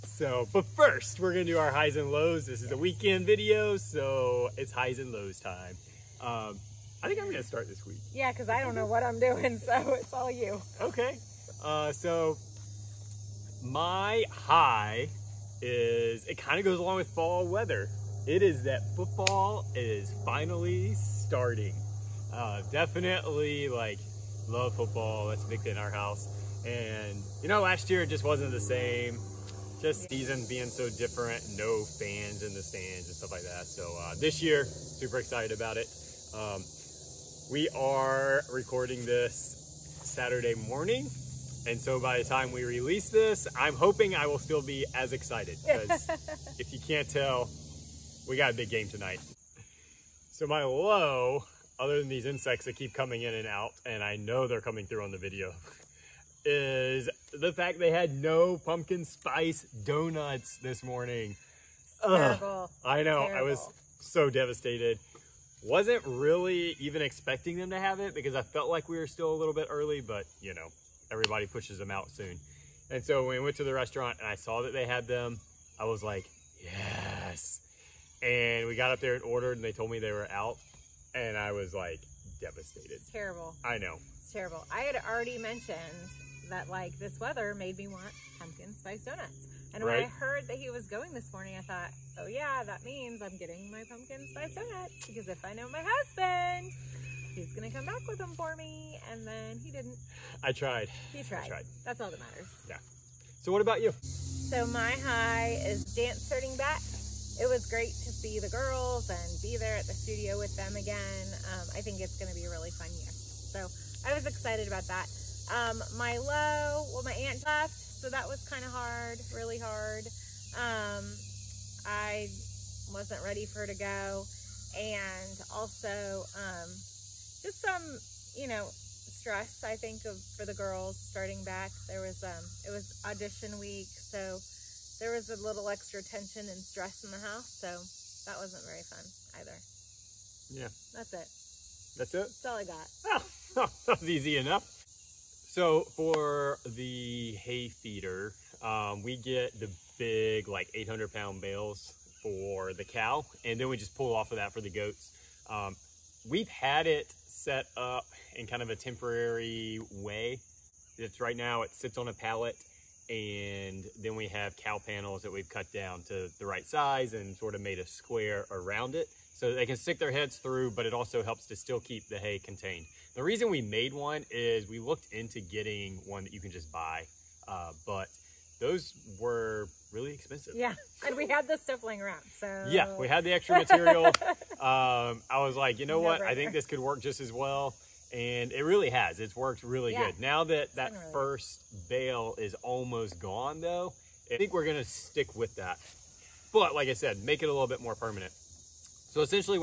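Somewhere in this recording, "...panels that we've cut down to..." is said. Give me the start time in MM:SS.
02:44.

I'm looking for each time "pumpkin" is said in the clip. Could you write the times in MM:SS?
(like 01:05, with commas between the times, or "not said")
00:58, 01:28, 01:33.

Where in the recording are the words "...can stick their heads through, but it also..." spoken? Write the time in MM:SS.
02:49.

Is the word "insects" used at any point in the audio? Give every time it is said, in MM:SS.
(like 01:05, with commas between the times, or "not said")
00:52.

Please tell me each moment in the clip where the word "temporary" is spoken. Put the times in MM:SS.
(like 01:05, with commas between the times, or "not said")
02:38.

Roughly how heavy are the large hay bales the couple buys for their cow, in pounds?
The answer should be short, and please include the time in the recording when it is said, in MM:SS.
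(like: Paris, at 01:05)
800 pounds, at 02:30.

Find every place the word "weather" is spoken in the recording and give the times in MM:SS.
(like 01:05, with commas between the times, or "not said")
00:17, 01:27.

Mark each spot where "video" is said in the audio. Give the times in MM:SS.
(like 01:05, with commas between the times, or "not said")
00:03, 00:55.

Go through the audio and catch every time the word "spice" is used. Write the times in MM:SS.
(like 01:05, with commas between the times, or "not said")
00:59, 01:28, 01:34.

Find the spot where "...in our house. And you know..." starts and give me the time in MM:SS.
00:25.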